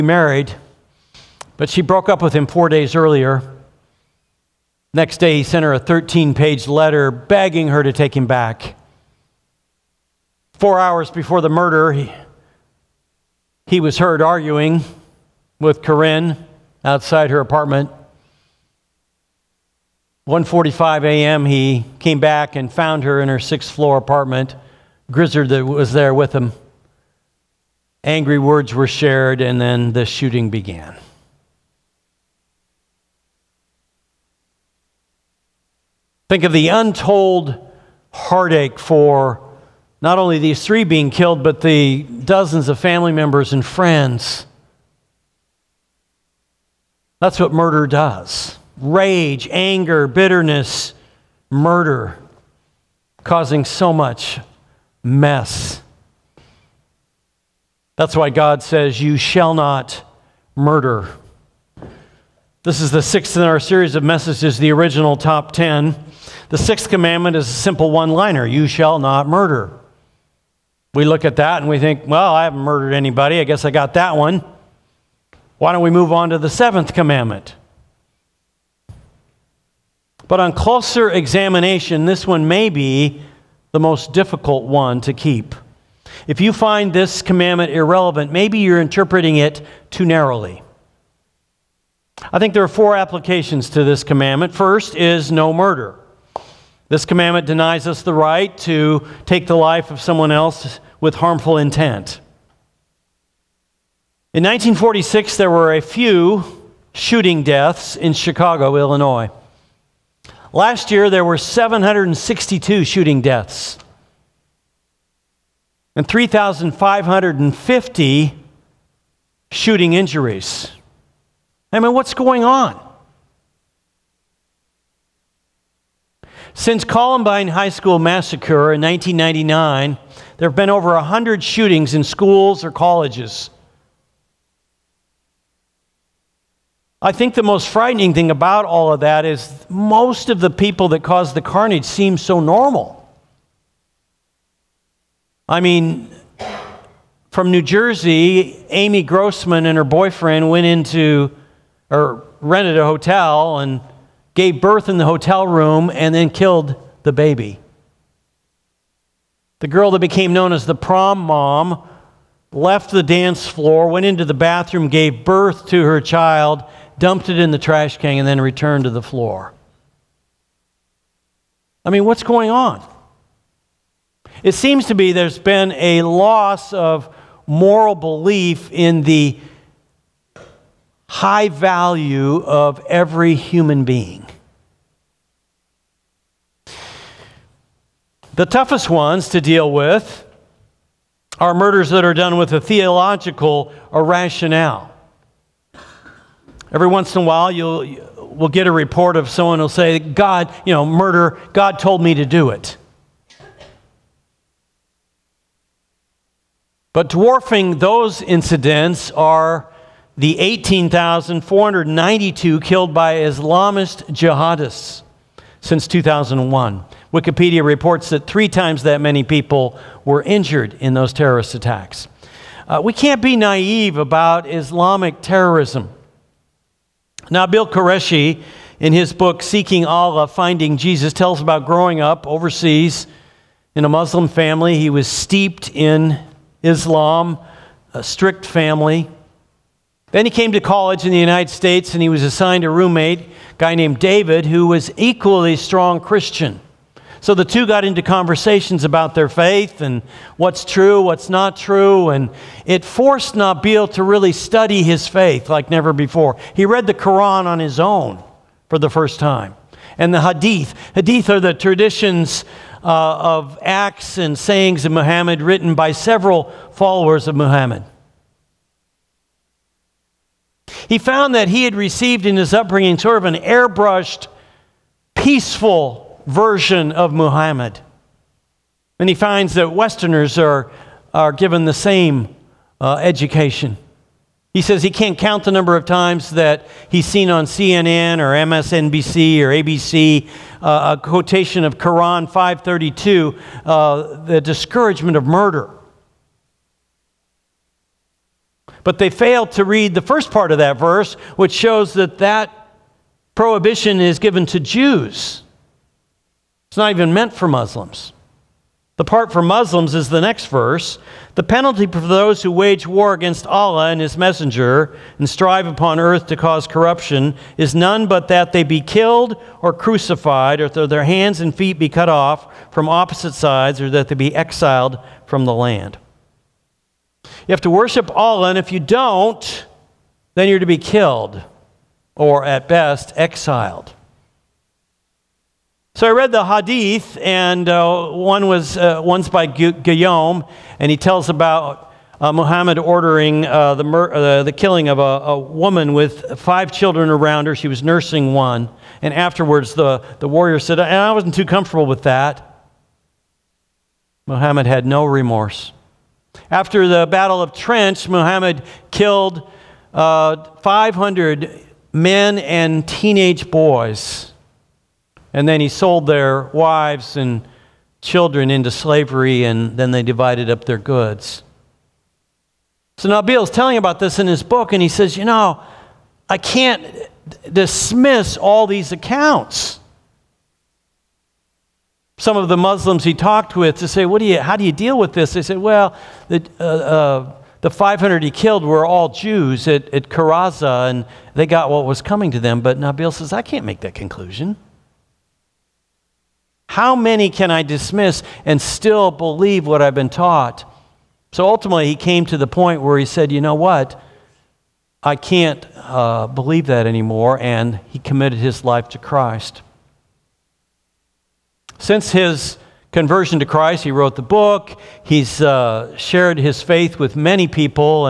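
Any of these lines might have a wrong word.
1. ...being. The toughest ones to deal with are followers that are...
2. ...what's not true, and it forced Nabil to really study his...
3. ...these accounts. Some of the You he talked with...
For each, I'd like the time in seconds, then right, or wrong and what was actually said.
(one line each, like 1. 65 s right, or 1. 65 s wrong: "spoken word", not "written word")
1. 183 s wrong: "murders", not "followers"
2. 251 s right
3. 378 s wrong: "Muslims", not "You".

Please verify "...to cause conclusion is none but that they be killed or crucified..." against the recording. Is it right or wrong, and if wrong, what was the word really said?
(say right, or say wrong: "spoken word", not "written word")
wrong: "corruption", not "conclusion".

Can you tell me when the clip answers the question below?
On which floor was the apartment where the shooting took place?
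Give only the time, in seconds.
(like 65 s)
23 s.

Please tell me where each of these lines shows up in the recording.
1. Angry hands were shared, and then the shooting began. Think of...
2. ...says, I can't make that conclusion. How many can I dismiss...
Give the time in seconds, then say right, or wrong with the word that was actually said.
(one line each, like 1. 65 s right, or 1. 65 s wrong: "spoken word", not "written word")
1. 28 s wrong: "words", not "hands"
2. 393 s right.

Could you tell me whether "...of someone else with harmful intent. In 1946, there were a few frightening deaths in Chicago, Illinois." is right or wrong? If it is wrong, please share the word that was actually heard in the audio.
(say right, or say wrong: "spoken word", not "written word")
wrong: "shooting", not "frightening".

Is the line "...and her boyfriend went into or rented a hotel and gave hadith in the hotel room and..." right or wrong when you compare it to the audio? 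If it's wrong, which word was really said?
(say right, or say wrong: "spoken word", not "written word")
wrong: "birth", not "hadith".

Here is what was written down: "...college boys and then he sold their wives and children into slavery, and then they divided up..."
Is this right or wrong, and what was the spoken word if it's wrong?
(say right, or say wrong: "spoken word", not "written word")
wrong: "teenage", not "college".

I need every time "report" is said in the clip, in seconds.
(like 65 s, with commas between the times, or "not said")
198 s, 217 s.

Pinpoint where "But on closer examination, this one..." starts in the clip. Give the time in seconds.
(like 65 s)
80 s.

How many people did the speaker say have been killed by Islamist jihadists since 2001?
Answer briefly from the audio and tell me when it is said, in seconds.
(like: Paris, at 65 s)
18,492, at 210 s.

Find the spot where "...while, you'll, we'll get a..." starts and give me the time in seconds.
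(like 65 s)
197 s.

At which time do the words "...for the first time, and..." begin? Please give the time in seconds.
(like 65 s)
258 s.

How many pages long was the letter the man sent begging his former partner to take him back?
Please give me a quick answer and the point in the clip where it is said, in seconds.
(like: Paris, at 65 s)
13, at 5 s.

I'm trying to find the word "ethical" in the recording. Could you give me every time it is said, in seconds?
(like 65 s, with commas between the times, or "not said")
not said.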